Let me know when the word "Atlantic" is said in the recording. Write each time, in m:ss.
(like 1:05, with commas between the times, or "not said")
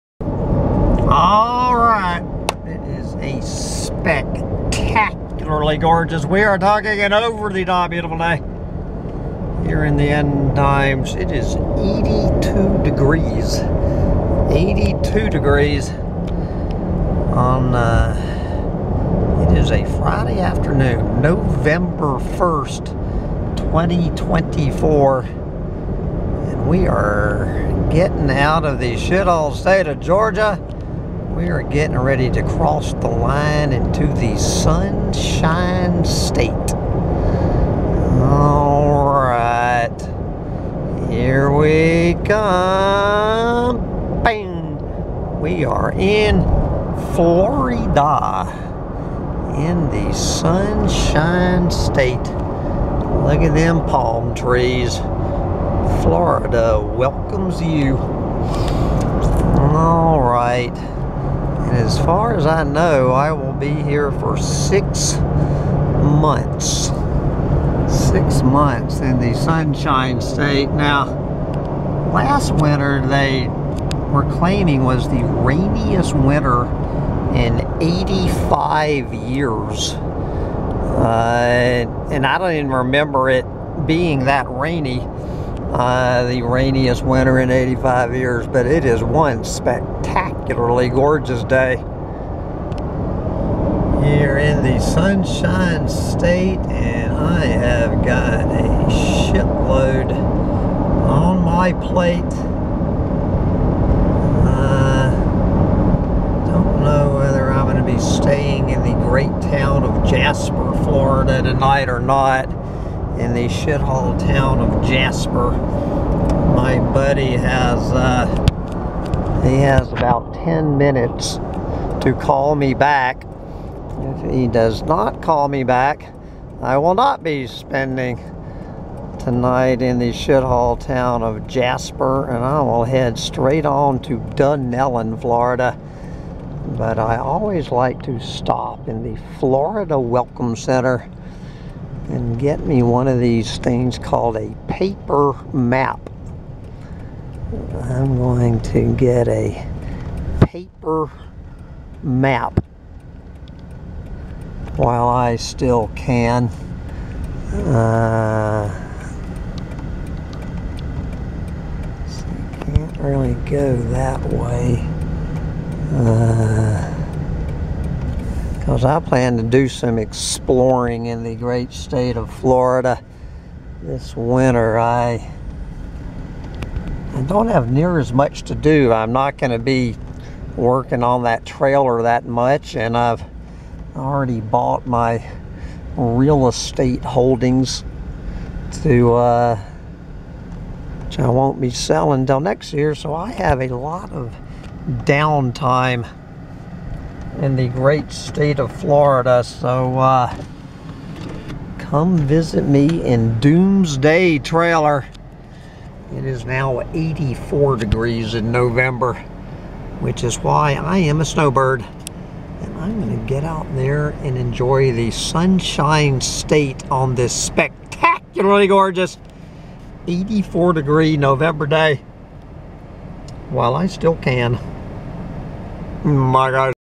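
not said.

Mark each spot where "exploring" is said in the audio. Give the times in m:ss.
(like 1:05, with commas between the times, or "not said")
2:49.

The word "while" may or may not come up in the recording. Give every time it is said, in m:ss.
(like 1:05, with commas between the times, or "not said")
2:34, 3:43.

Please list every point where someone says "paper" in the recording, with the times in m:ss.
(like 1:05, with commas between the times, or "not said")
2:24, 2:30.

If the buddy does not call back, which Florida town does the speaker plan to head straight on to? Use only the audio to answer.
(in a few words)
Dunnellon, Florida.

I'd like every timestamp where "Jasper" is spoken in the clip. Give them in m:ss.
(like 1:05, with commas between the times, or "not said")
1:50, 1:54, 2:11.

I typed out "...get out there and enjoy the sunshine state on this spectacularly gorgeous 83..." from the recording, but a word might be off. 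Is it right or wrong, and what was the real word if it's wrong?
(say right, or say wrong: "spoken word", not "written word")
wrong: "84", not "83".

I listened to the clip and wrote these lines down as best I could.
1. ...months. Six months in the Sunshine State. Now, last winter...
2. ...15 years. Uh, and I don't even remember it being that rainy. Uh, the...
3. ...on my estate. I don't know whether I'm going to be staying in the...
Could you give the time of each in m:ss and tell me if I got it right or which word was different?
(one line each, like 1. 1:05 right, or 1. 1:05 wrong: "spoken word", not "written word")
1. 1:06 right
2. 1:17 wrong: "85", not "15"
3. 1:40 wrong: "plate", not "estate".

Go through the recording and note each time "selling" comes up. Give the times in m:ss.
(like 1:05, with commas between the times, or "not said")
3:11.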